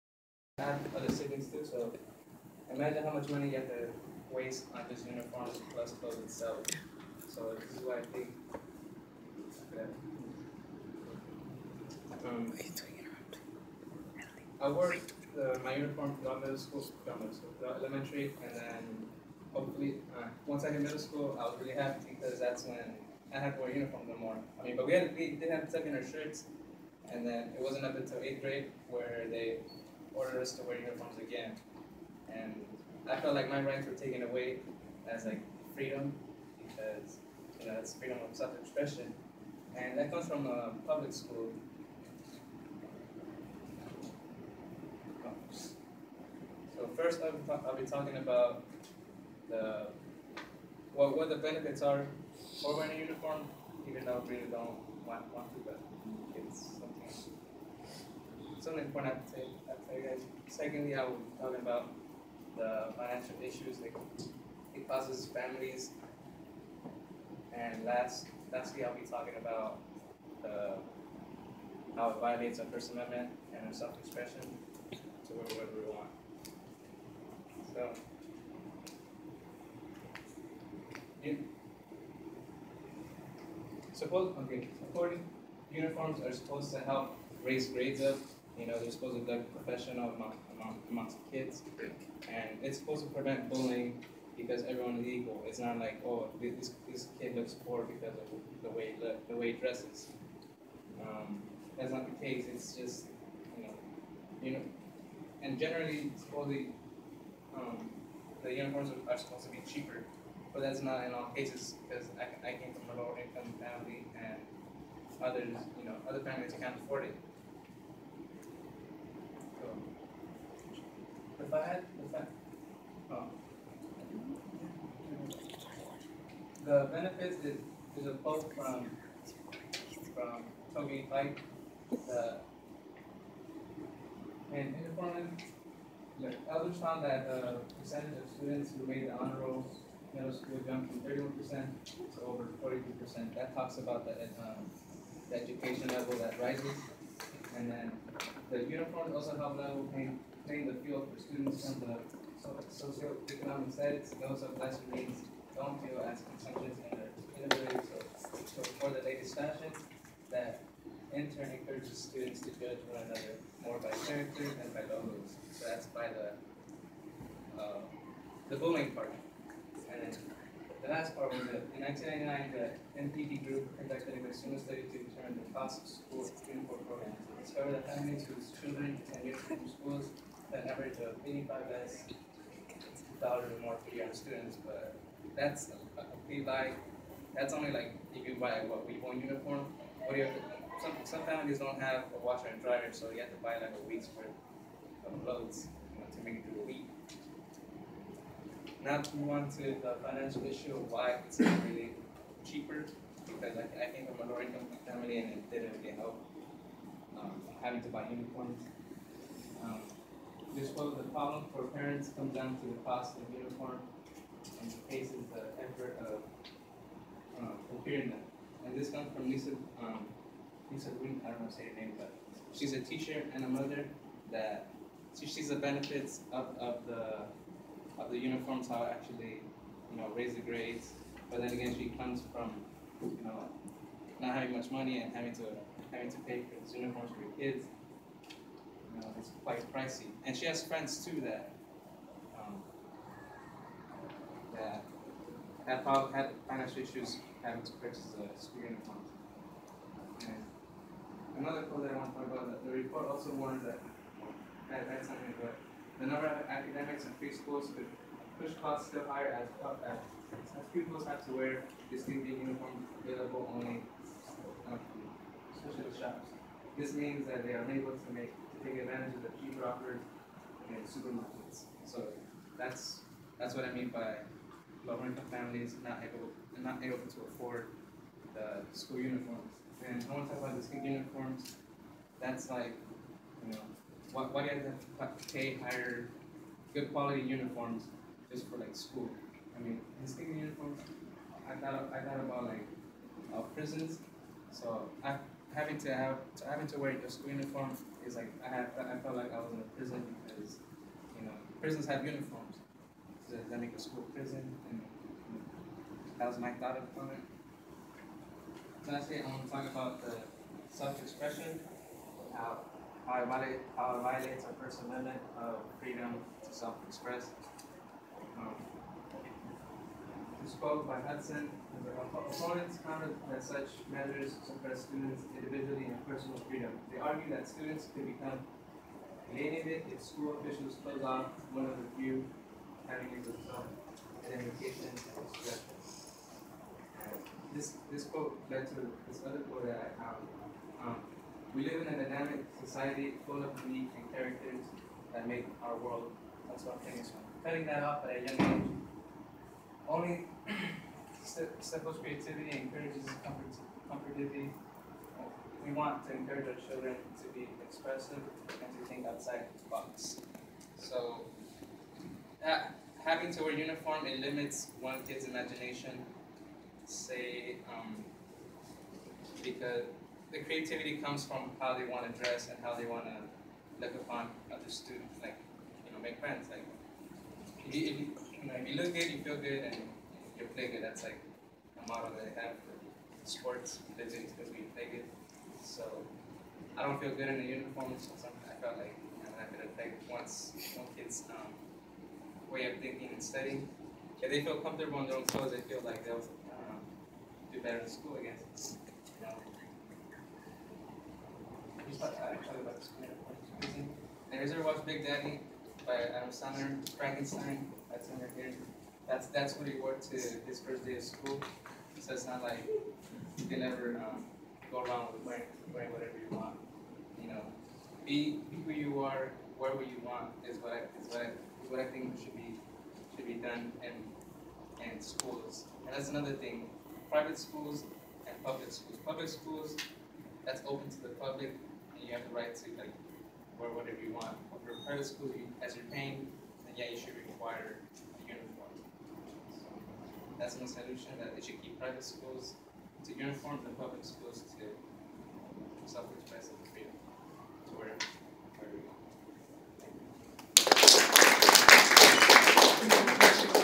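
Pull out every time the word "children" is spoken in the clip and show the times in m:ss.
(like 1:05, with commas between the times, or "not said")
2:58, 5:56.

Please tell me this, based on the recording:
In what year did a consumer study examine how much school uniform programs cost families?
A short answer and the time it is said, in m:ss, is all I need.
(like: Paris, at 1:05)
1999, at 2:51.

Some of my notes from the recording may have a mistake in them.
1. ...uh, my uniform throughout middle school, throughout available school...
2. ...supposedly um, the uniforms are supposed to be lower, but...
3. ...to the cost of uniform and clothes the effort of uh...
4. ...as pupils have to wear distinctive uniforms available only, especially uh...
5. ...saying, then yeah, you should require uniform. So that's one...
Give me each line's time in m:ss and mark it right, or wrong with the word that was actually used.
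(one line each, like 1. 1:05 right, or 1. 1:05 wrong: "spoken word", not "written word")
1. 0:15 wrong: "middle", not "available"
2. 1:46 wrong: "cheaper", not "lower"
3. 3:32 wrong: "faces", not "clothes"
4. 4:20 right
5. 7:15 wrong: "paying", not "saying".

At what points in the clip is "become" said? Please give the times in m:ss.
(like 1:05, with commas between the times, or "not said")
5:28.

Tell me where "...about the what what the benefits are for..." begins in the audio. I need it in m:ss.
0:48.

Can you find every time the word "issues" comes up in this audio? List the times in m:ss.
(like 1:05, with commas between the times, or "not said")
1:03, 3:20, 4:06.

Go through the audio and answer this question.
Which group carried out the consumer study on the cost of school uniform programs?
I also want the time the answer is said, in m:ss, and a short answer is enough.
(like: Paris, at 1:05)
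NPD group, at 2:53.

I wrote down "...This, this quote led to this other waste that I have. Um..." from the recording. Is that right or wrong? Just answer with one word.
wrong.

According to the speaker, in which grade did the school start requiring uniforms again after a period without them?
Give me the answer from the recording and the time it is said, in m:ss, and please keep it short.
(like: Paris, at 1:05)
Eighth grade, at 0:28.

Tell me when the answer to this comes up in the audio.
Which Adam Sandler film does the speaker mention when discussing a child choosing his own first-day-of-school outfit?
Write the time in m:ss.
6:44.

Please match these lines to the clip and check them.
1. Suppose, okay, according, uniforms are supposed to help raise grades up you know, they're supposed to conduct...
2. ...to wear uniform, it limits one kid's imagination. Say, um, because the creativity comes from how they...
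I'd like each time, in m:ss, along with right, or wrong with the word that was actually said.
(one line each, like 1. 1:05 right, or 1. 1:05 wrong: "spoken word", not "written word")
1. 1:23 right
2. 6:03 right.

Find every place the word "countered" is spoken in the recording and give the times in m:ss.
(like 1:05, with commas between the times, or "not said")
5:22.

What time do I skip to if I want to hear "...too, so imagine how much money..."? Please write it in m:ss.
0:01.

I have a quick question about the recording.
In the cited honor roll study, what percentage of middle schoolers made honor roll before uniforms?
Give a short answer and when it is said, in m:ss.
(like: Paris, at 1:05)
31%, at 2:21.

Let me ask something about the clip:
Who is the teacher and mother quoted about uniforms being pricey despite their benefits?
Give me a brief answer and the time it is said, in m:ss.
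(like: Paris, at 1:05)
Lisa Green, at 3:40.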